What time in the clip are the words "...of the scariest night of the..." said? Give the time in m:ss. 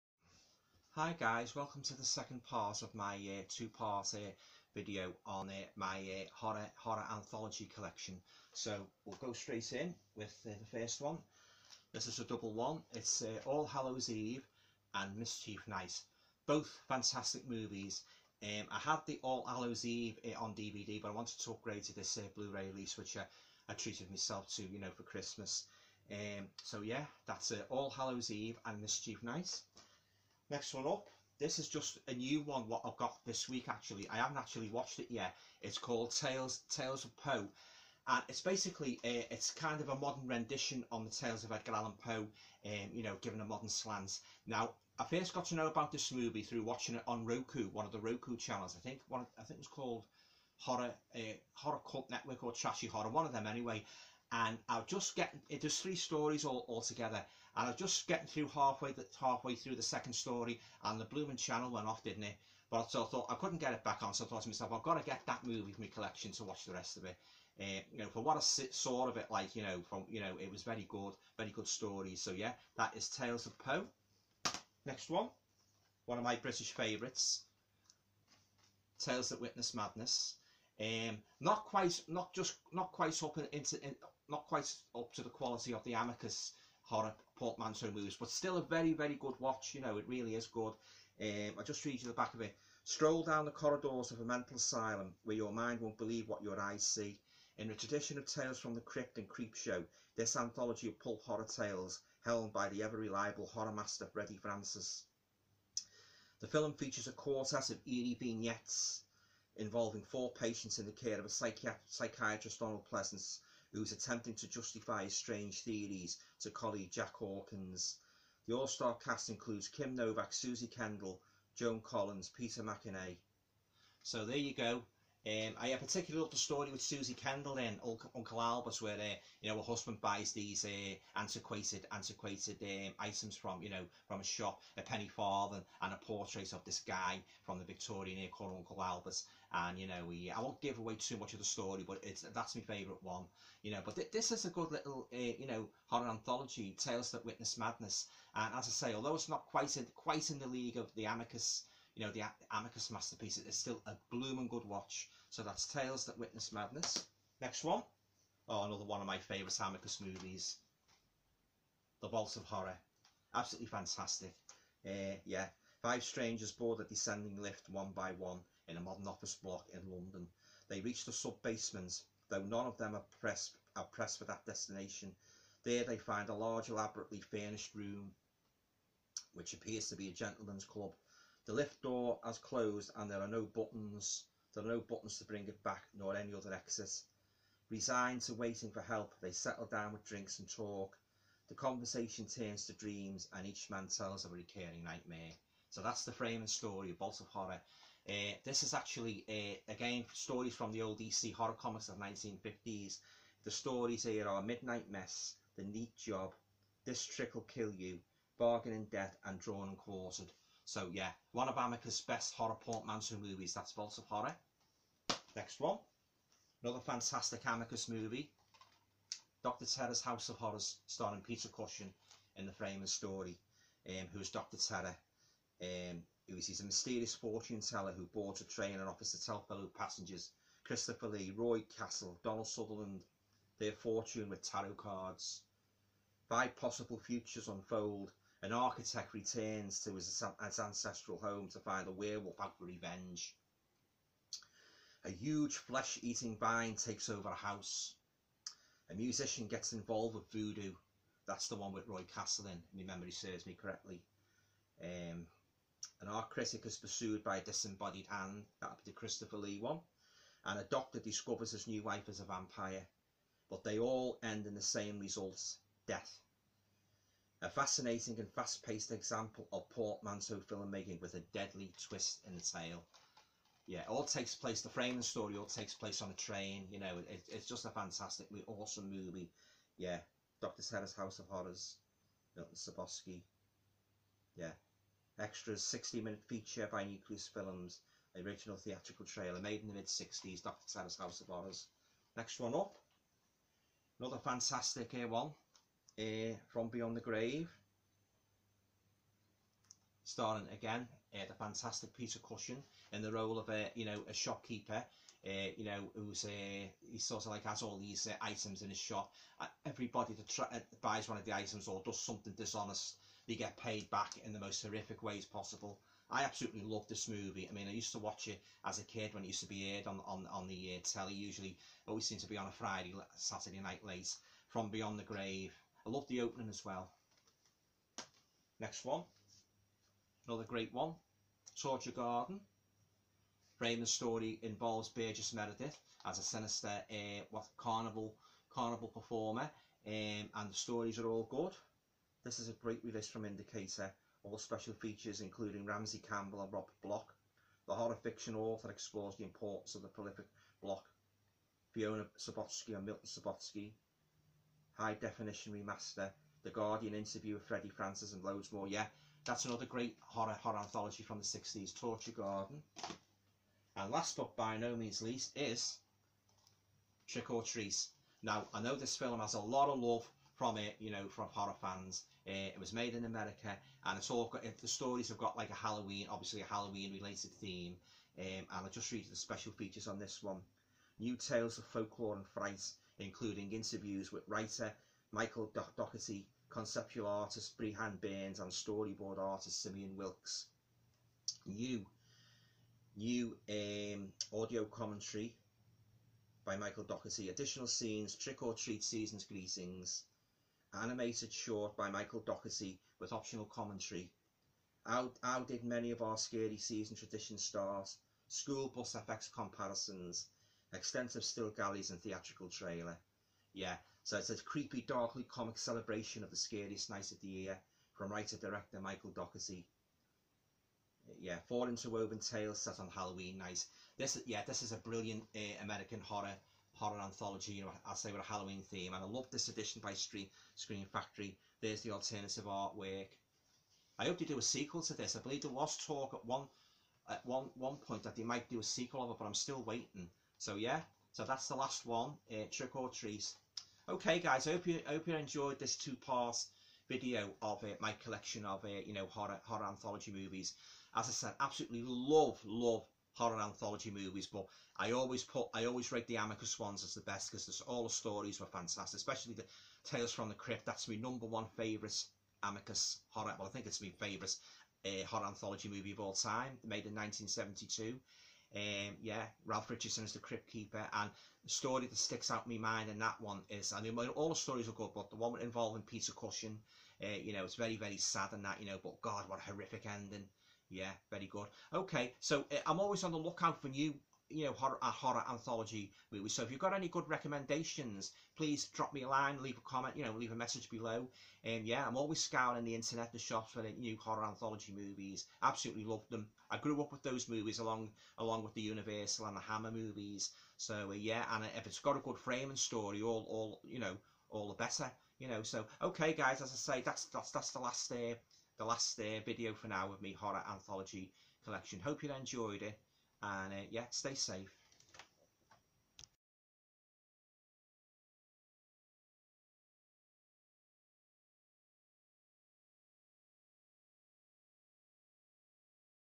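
6:56.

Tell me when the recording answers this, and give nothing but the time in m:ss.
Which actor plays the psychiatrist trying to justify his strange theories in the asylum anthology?
1:52.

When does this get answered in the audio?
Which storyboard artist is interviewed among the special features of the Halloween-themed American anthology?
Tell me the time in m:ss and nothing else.
6:29.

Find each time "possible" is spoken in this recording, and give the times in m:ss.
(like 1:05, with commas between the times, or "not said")
3:56, 5:15.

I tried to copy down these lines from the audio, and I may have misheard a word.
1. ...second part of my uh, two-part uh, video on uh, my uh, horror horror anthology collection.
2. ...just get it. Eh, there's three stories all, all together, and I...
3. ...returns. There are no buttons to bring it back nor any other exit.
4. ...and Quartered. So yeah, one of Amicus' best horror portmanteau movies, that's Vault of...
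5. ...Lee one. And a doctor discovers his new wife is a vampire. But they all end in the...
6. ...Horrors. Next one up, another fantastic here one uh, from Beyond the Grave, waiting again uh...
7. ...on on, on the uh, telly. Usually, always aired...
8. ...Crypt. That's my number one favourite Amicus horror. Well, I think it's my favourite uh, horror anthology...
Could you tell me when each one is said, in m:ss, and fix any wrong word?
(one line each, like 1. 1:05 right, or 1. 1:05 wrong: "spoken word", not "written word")
1. 0:02 right
2. 0:54 right
3. 3:03 wrong: "buttons", not "returns"
4. 3:29 right
5. 4:19 right
6. 4:51 wrong: "starring", not "waiting"
7. 5:19 wrong: "seemed", not "aired"
8. 7:40 right.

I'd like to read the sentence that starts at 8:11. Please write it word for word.
And um, yeah, I'm always scouring the internet, the shops for the new horror anthology movies.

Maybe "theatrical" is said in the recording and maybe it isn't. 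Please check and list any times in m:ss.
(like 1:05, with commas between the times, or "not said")
4:48, 6:52.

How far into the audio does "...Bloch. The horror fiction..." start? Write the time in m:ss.
5:46.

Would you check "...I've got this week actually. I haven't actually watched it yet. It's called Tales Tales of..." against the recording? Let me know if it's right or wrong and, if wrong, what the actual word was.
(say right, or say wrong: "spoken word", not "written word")
right.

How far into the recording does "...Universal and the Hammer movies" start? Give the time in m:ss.
8:18.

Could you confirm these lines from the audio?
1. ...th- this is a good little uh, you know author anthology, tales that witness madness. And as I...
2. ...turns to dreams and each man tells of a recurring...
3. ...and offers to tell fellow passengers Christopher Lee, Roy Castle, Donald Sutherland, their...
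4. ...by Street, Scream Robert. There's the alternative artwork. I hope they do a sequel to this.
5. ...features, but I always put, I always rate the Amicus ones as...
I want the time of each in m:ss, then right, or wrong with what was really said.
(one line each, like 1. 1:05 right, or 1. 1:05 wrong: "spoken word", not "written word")
1. 2:23 wrong: "horror", not "author"
2. 3:12 right
3. 3:48 right
4. 7:09 wrong: "Factory", not "Robert"
5. 7:33 wrong: "movies", not "features".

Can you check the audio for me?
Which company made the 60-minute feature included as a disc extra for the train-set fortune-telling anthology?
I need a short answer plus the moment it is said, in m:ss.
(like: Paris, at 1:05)
Nucleus Films, at 4:46.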